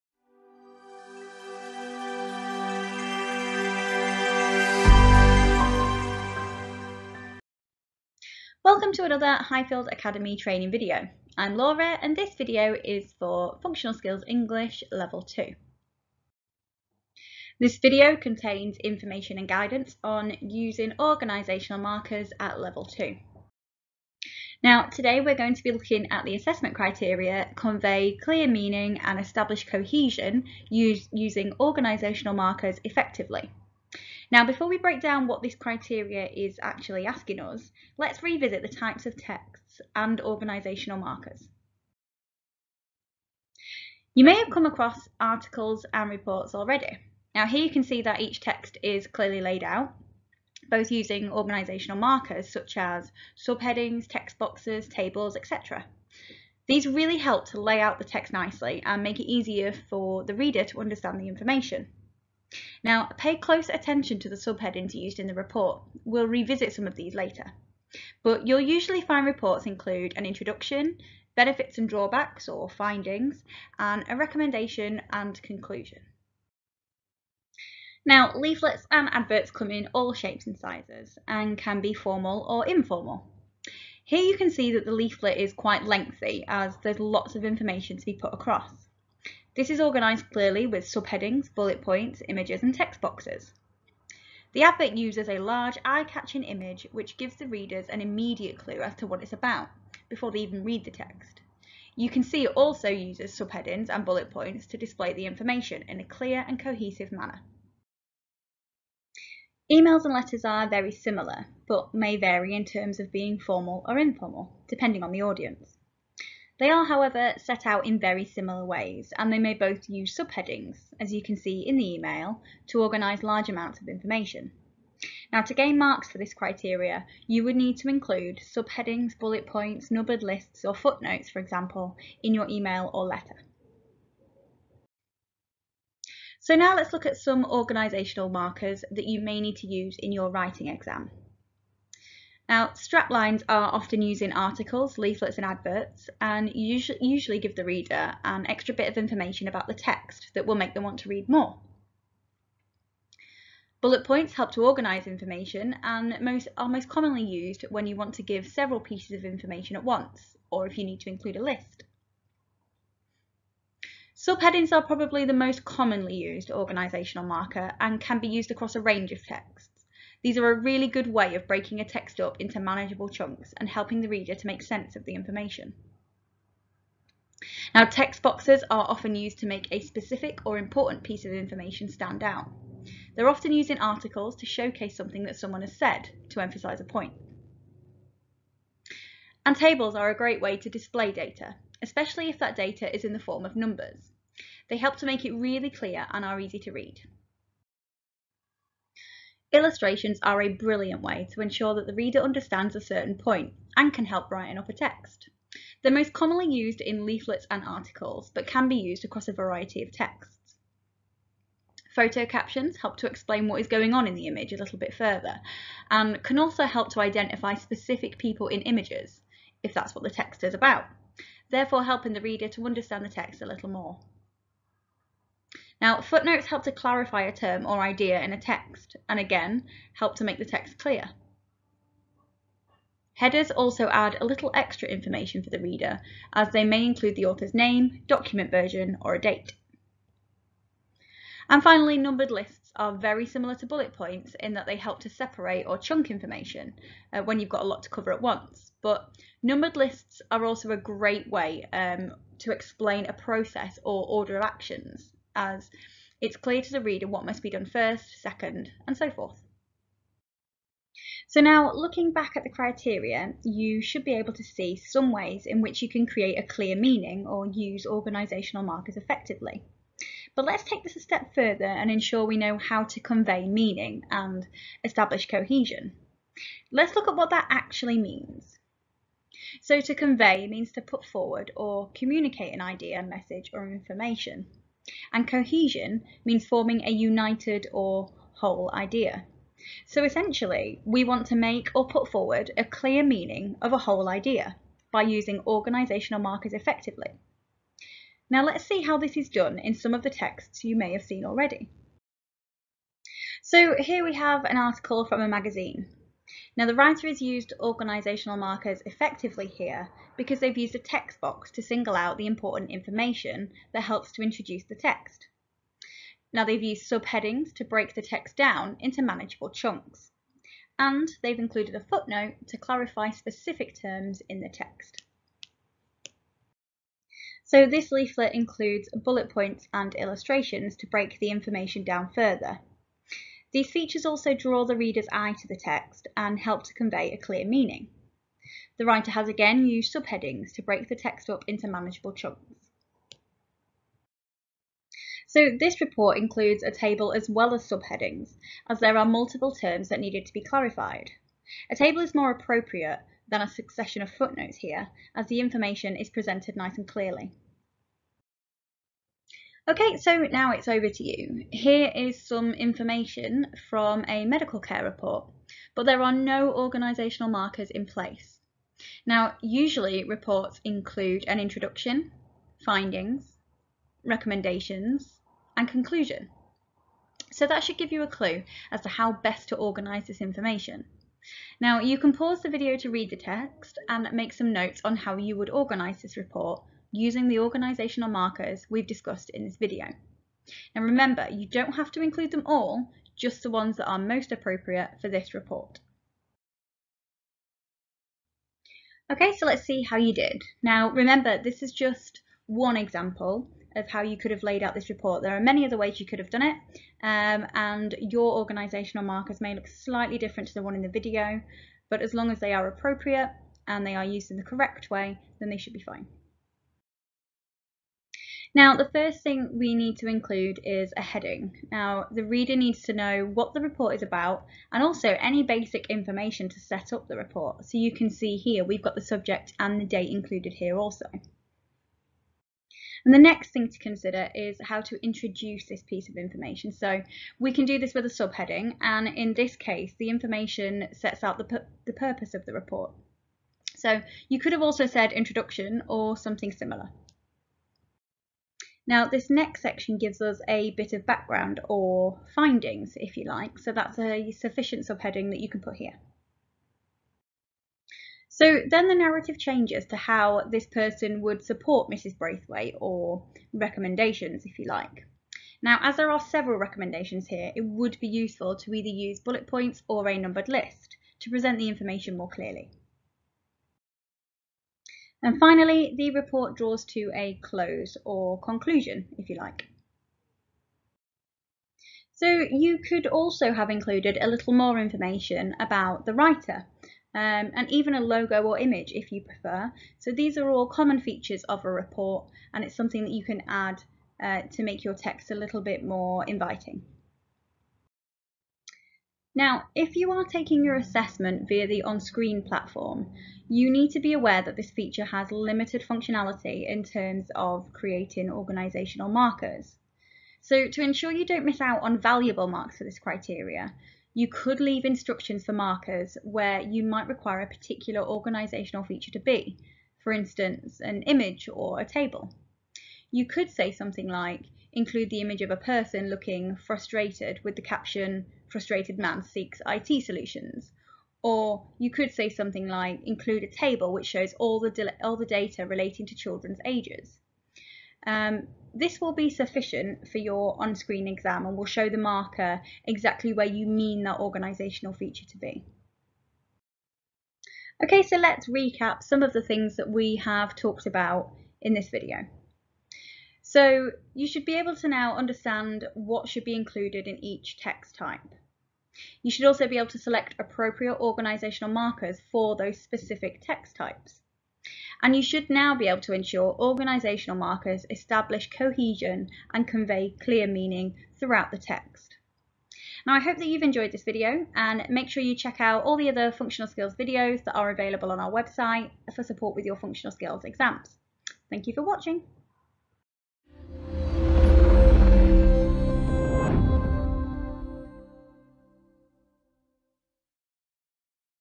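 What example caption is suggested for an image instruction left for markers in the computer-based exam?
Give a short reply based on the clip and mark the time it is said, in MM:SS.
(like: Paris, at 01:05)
Frustrated man seeks IT solutions, at 08:48.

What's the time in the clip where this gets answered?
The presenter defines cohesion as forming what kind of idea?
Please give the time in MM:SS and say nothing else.
04:46.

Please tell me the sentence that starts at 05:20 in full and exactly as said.
And they've included a footnote to clarify specific terms in the text.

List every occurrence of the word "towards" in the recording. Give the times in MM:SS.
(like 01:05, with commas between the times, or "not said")
not said.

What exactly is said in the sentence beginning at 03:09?
And tables are a great way to display data, especially if that data is in the form of numbers.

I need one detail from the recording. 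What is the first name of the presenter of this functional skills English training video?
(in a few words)
Laura.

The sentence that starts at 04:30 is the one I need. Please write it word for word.
But let's take this a step further and ensure we know how to convey meaning and establish cohesion.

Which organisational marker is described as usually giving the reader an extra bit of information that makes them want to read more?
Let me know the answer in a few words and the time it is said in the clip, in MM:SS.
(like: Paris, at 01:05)
Straplines, at 02:22.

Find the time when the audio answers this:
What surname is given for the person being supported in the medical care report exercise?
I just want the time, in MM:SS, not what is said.
07:42.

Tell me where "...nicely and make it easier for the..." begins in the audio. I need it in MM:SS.
00:58.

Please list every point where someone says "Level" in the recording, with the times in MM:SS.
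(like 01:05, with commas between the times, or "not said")
00:14, 00:22.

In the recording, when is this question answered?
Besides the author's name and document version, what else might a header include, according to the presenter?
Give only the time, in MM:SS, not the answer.
03:59.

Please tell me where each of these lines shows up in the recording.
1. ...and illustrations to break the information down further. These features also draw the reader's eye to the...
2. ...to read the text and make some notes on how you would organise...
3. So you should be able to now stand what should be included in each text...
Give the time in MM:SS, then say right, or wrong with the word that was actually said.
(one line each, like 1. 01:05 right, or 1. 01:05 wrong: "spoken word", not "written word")
1. 05:29 right
2. 06:22 right
3. 09:13 wrong: "understand", not "stand".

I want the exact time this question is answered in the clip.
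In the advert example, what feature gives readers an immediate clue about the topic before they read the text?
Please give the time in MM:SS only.
01:35.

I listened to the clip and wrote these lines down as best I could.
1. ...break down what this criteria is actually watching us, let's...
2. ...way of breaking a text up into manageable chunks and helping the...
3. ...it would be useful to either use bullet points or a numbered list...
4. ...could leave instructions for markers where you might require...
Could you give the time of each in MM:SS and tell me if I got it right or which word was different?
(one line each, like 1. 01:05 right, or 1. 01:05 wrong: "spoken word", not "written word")
1. 00:34 wrong: "asking", not "watching"
2. 02:51 right
3. 07:47 right
4. 08:34 right.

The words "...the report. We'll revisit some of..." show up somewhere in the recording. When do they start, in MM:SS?
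01:05.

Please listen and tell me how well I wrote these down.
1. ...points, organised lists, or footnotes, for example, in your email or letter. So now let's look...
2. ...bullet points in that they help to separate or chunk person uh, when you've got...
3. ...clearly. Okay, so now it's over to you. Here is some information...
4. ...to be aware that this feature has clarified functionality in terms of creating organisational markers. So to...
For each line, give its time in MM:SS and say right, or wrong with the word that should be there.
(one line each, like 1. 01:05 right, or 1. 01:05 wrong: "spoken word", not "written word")
1. 02:09 wrong: "numbered", not "organised"
2. 04:03 wrong: "information", not "person"
3. 05:56 right
4. 08:23 wrong: "limited", not "clarified".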